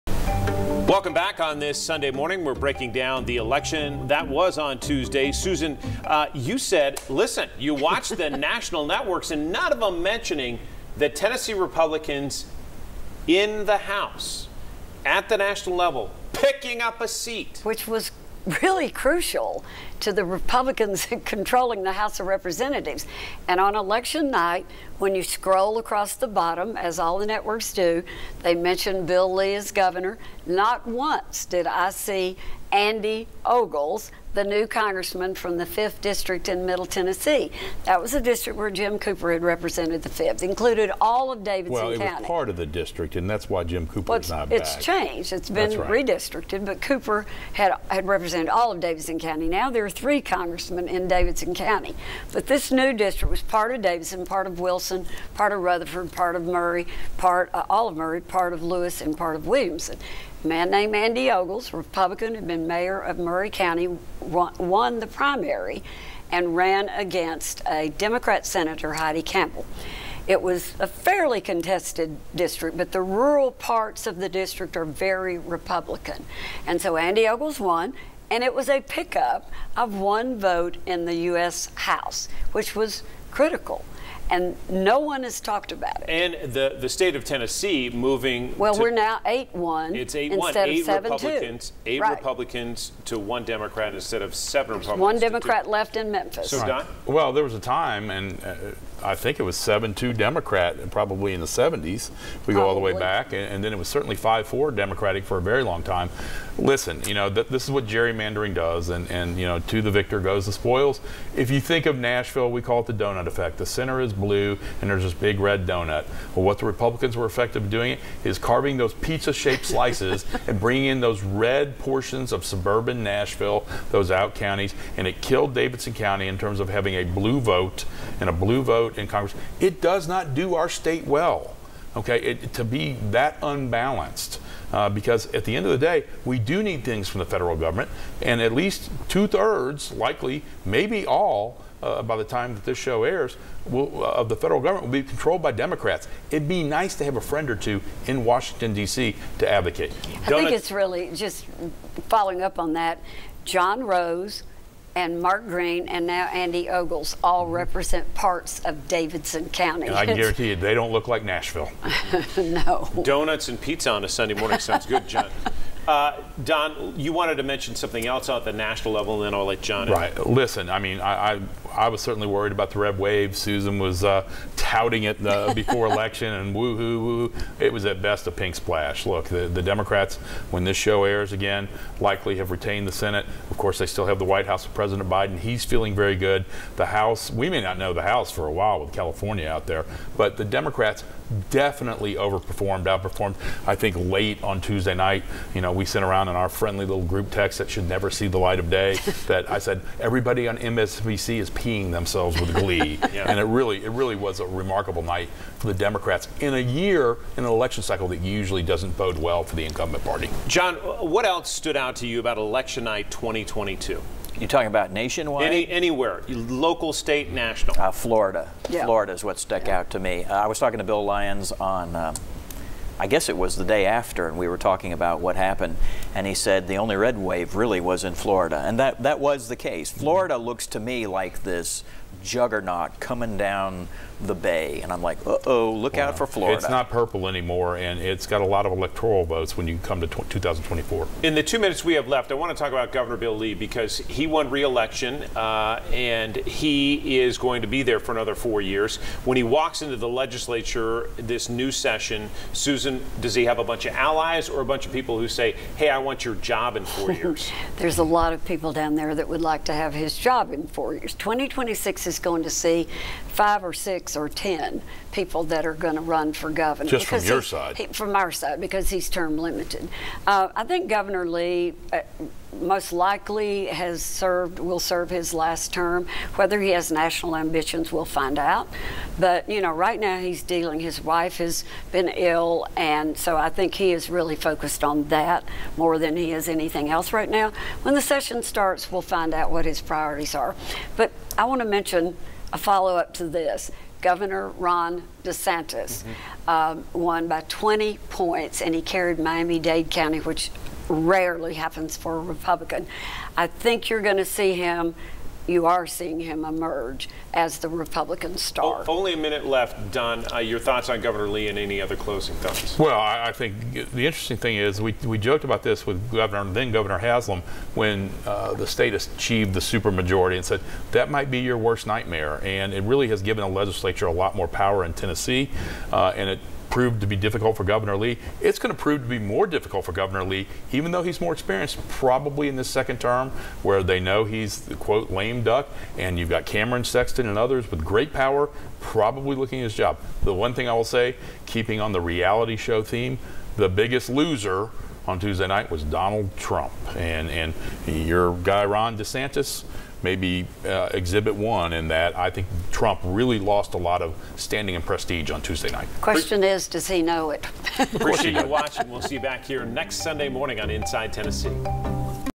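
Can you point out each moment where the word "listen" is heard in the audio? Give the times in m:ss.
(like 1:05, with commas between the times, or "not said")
0:07, 1:46, 2:50.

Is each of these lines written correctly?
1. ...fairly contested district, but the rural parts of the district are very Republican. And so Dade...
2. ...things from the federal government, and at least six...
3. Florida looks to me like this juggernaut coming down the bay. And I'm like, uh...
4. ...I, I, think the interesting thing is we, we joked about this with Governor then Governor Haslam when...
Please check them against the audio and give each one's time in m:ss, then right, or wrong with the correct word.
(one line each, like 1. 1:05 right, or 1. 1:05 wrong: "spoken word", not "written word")
1. 1:10 wrong: "Andy", not "Dade"
2. 2:16 wrong: "two", not "six"
3. 3:49 right
4. 5:12 right.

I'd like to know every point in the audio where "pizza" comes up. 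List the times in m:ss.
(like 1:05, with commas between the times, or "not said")
1:58, 2:43.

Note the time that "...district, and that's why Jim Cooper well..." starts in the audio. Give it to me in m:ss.
0:42.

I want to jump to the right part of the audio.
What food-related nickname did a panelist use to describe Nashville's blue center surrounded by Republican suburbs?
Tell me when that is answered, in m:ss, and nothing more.
1:52.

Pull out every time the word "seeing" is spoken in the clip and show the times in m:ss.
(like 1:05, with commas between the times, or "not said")
5:05.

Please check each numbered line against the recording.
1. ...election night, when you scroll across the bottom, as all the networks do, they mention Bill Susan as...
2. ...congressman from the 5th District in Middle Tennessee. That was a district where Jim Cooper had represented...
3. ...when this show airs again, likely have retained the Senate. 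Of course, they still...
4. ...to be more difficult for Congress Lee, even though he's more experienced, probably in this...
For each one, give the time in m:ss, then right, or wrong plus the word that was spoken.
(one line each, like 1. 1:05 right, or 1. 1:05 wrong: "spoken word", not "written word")
1. 0:23 wrong: "Lee", not "Susan"
2. 0:34 right
3. 3:00 right
4. 5:29 wrong: "Governor", not "Congress".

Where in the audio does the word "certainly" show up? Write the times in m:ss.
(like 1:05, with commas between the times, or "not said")
1:43, 2:52.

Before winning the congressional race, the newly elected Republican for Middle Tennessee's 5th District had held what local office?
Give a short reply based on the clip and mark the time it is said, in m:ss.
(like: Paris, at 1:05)
Mayor of Maury County, at 1:02.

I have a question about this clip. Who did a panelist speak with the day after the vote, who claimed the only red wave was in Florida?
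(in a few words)
Bill Lyons.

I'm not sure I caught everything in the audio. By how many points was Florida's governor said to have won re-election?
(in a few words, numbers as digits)
20 points.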